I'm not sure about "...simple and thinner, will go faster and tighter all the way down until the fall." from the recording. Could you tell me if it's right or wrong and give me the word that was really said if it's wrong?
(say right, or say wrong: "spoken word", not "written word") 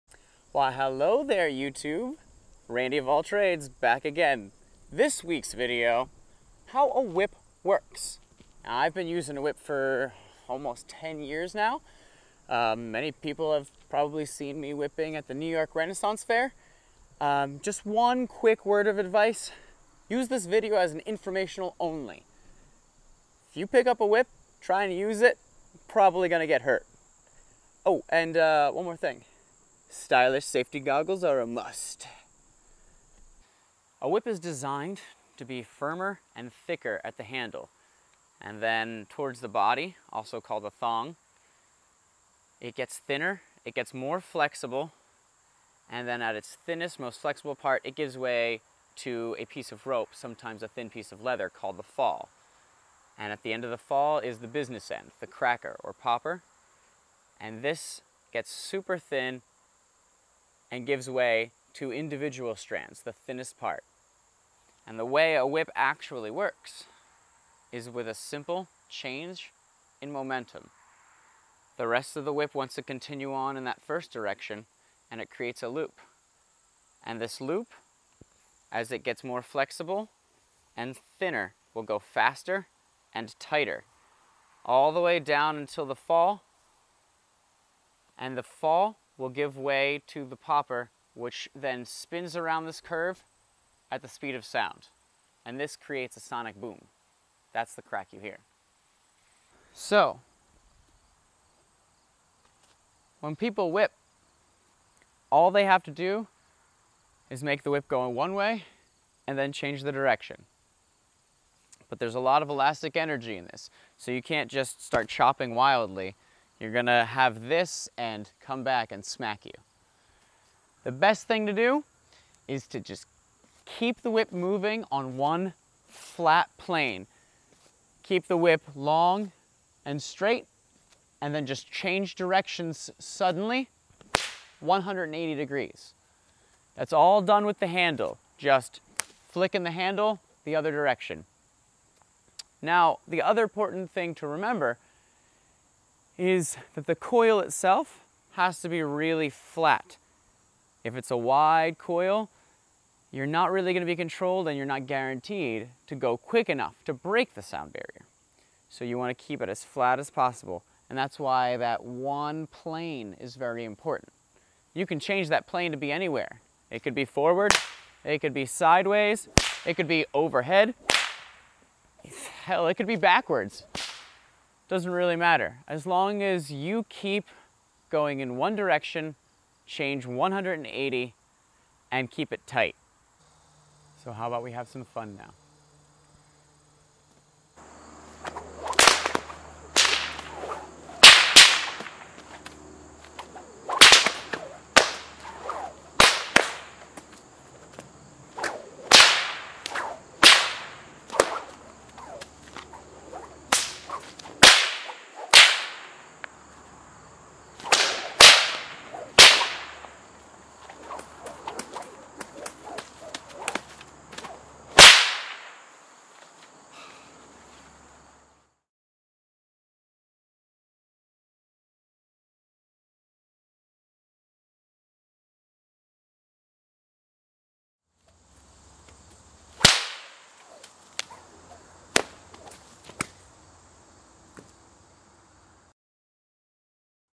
wrong: "flexible", not "simple".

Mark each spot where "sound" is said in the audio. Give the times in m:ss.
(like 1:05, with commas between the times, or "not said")
1:34, 2:37.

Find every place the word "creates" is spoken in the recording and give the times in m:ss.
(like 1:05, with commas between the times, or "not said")
1:15, 1:35.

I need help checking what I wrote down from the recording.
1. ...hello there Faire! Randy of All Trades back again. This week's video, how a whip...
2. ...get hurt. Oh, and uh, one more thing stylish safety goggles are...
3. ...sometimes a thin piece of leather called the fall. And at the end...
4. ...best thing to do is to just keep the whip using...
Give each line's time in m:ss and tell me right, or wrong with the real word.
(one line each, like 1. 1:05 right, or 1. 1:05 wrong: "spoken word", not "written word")
1. 0:00 wrong: "YouTube", not "Faire"
2. 0:26 right
3. 0:50 right
4. 2:00 wrong: "moving", not "using".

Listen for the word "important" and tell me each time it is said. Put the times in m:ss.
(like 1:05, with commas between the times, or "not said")
2:23, 2:43.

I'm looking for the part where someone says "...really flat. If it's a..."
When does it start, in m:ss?
2:28.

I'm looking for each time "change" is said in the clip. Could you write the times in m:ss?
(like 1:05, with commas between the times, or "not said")
1:08, 1:49, 2:11, 2:44, 2:59.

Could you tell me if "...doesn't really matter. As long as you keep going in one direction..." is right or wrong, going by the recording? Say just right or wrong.
right.